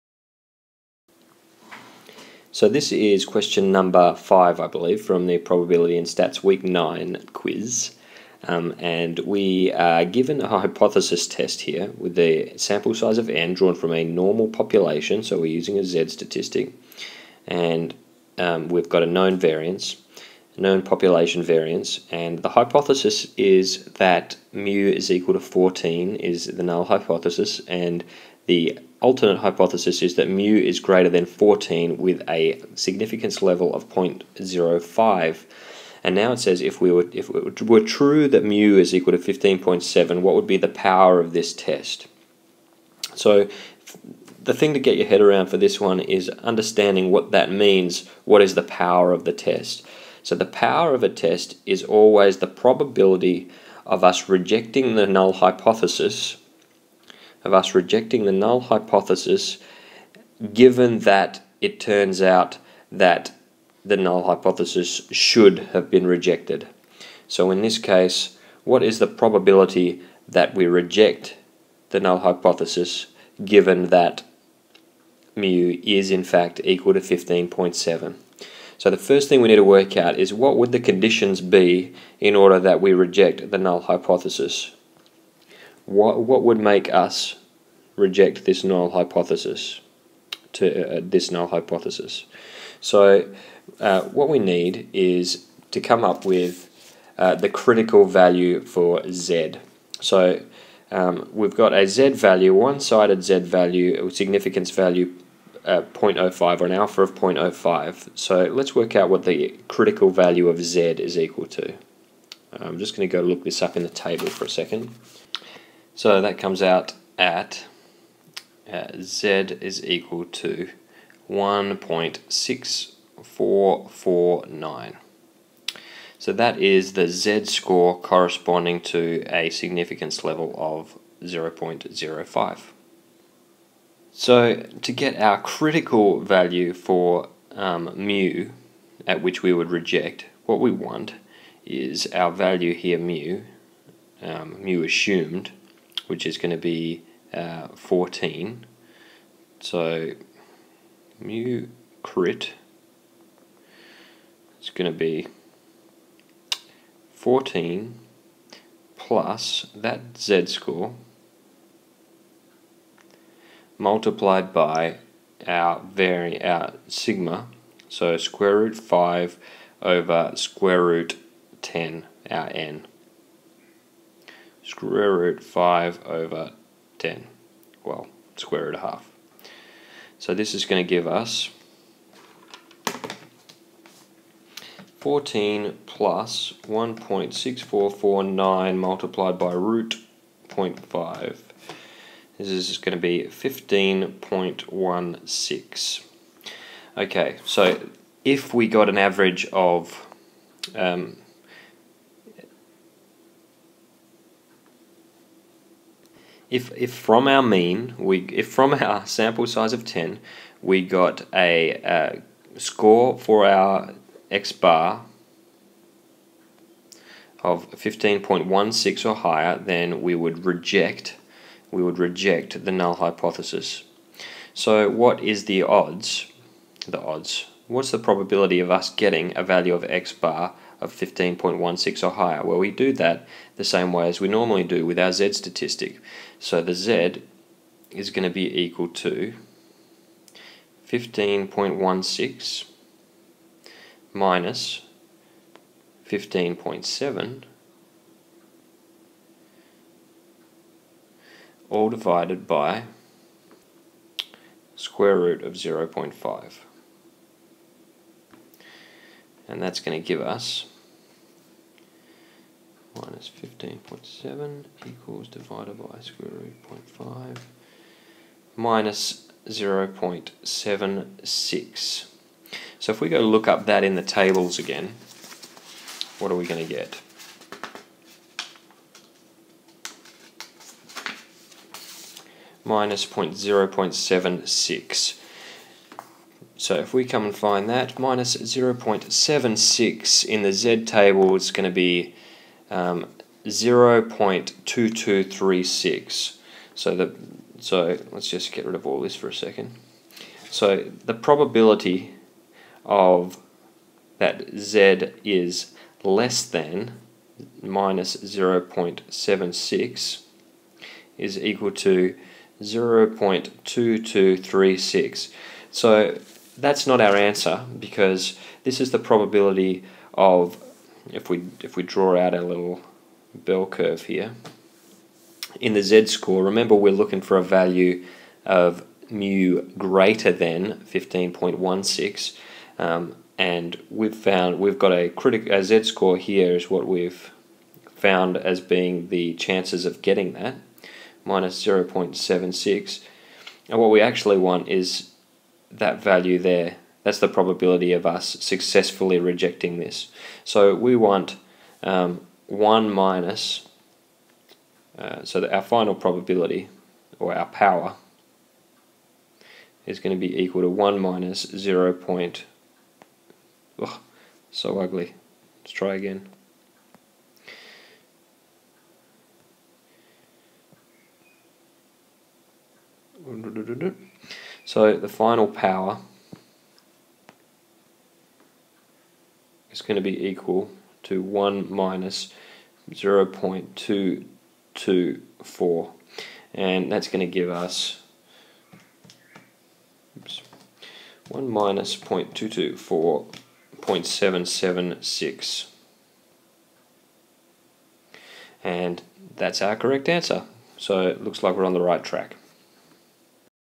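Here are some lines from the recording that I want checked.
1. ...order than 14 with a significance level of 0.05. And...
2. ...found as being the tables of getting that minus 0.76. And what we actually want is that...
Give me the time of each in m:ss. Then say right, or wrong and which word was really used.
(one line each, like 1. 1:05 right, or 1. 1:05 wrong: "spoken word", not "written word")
1. 0:30 wrong: "greater", not "order"
2. 5:37 wrong: "chances", not "tables".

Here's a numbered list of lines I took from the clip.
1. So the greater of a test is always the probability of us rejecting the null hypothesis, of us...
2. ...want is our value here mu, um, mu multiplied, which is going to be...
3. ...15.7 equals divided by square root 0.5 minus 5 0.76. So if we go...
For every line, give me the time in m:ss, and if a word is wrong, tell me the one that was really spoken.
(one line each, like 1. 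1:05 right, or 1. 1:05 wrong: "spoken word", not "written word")
1. 0:50 wrong: "power", not "greater"
2. 2:20 wrong: "assumed", not "multiplied"
3. 4:23 wrong: "0", not "5".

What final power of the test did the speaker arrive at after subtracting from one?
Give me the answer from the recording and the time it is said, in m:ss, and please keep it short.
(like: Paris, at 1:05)
0.776, at 6:33.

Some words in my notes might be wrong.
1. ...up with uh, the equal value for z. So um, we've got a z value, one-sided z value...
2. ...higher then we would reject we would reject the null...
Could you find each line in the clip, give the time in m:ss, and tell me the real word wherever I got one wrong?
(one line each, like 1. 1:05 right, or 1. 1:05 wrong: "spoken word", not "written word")
1. 1:36 wrong: "critical", not "equal"
2. 3:39 right.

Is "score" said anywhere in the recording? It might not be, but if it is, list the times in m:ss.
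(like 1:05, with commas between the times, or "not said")
2:07, 2:40, 3:32, 5:25, 5:35.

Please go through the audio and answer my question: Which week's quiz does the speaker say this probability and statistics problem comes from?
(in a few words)
Week 9.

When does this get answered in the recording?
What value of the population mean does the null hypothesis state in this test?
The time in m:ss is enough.
0:24.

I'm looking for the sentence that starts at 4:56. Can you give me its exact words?
So, the, so let's just get rid of all this for a second.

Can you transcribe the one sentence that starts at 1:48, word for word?
So let's work out what the critical value of z is equal to.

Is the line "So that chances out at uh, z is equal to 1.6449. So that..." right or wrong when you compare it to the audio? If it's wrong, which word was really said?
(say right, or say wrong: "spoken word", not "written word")
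wrong: "comes", not "chances".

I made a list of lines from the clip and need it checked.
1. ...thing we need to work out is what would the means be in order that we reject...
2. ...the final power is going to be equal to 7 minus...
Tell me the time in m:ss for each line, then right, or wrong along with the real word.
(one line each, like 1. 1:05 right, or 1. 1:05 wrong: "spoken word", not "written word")
1. 1:19 wrong: "conditions", not "means"
2. 6:14 wrong: "1", not "7".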